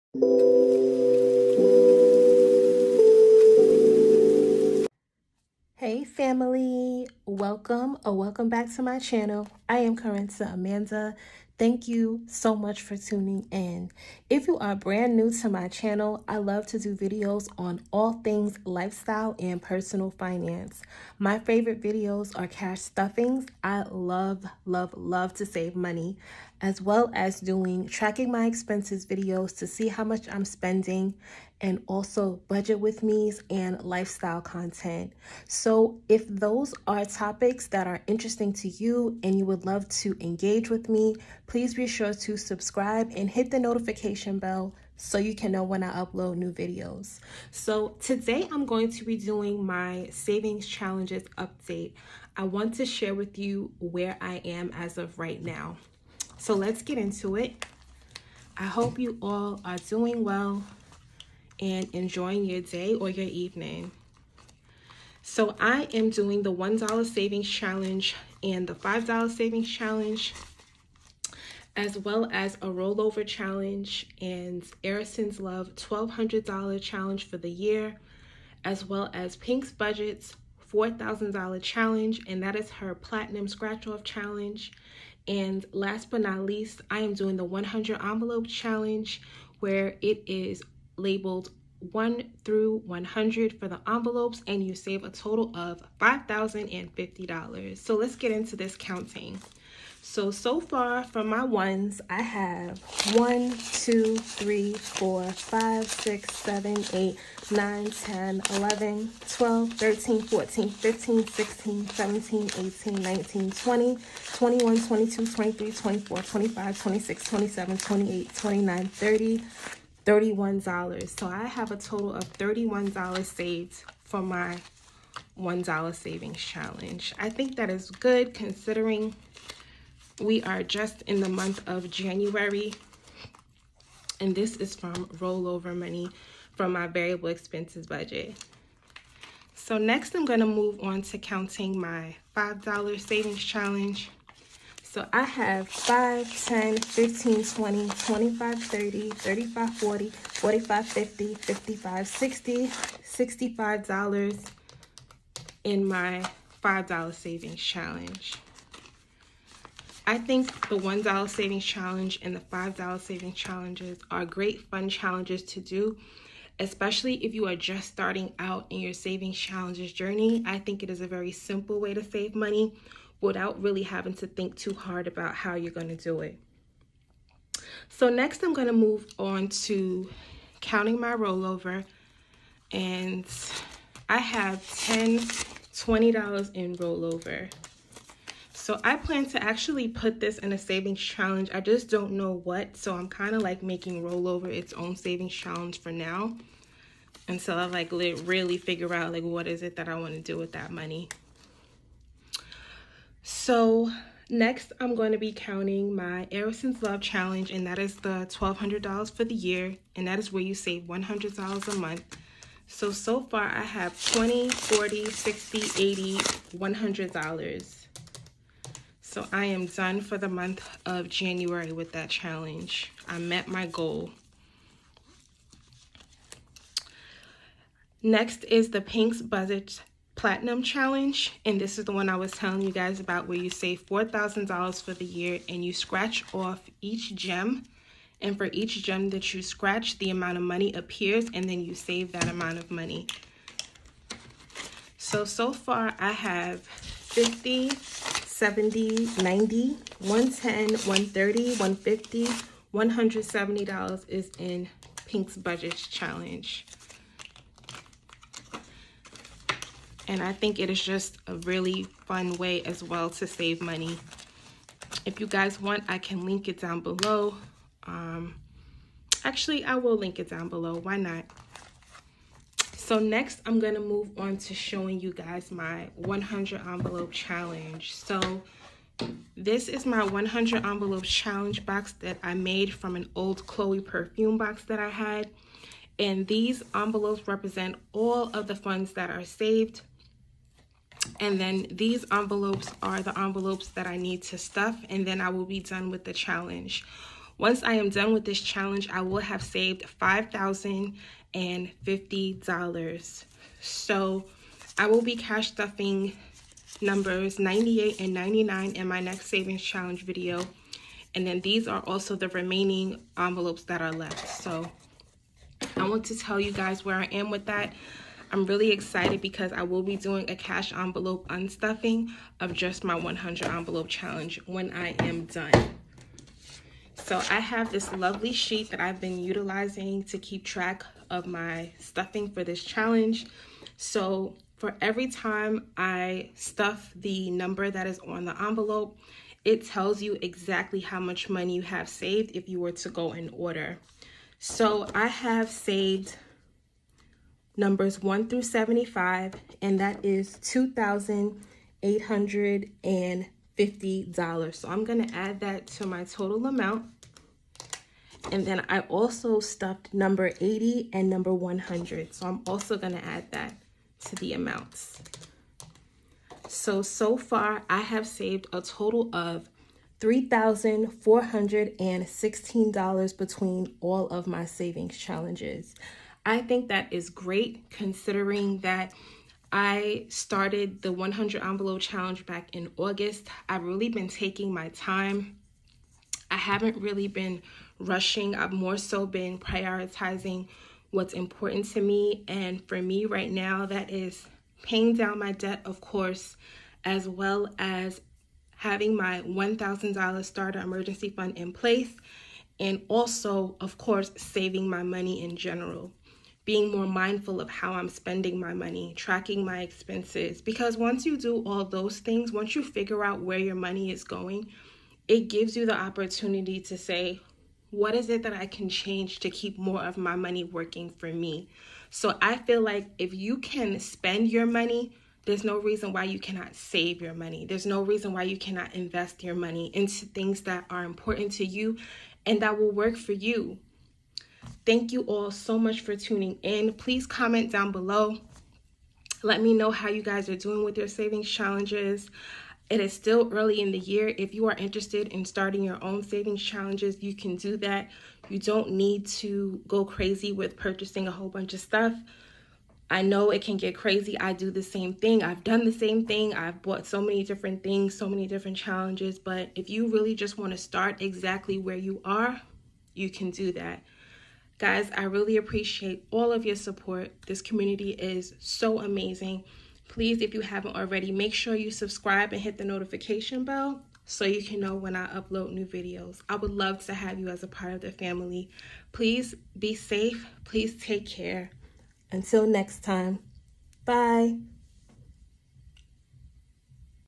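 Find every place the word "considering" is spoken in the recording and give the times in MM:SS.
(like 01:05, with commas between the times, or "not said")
02:08, 06:17.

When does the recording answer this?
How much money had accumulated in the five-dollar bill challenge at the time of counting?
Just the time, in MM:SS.
02:32.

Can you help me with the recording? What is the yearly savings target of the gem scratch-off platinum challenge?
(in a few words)
$4,000.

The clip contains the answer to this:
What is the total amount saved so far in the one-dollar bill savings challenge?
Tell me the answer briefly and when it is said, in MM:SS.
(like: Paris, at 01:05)
$31, at 02:01.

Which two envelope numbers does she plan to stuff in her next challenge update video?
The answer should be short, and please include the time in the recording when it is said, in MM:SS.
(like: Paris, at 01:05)
98 and 99, at 05:06.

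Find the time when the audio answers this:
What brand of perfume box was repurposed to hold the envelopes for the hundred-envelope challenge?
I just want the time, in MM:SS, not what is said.
04:43.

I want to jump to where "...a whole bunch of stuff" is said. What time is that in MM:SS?
07:31.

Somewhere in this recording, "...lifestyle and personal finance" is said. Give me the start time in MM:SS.
00:18.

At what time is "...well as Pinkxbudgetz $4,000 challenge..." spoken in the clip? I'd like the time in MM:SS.
01:18.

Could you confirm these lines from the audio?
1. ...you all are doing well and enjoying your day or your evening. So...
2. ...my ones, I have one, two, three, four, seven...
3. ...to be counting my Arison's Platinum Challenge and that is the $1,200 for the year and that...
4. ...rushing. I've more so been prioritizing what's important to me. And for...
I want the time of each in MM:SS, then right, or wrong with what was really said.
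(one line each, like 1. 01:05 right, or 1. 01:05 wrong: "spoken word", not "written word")
1. 00:58 right
2. 01:41 wrong: "five", not "seven"
3. 03:25 wrong: "Love", not "Platinum"
4. 06:27 right.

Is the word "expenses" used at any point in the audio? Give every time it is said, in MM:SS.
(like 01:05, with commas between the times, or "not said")
00:28, 02:17, 06:49.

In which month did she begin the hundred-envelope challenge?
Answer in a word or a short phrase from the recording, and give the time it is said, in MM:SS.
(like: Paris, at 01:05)
August, at 06:22.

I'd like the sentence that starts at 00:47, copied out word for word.
So today I'm going to be doing my savings challenges update.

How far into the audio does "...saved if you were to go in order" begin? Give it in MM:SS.
05:41.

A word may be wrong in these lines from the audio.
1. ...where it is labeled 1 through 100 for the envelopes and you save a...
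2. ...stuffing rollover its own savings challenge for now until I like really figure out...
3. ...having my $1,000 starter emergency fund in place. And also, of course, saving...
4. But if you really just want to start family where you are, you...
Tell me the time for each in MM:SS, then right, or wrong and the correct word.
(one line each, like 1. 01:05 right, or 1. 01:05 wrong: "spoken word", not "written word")
1. 01:29 right
2. 03:13 wrong: "making", not "stuffing"
3. 06:38 right
4. 07:39 wrong: "exactly", not "family".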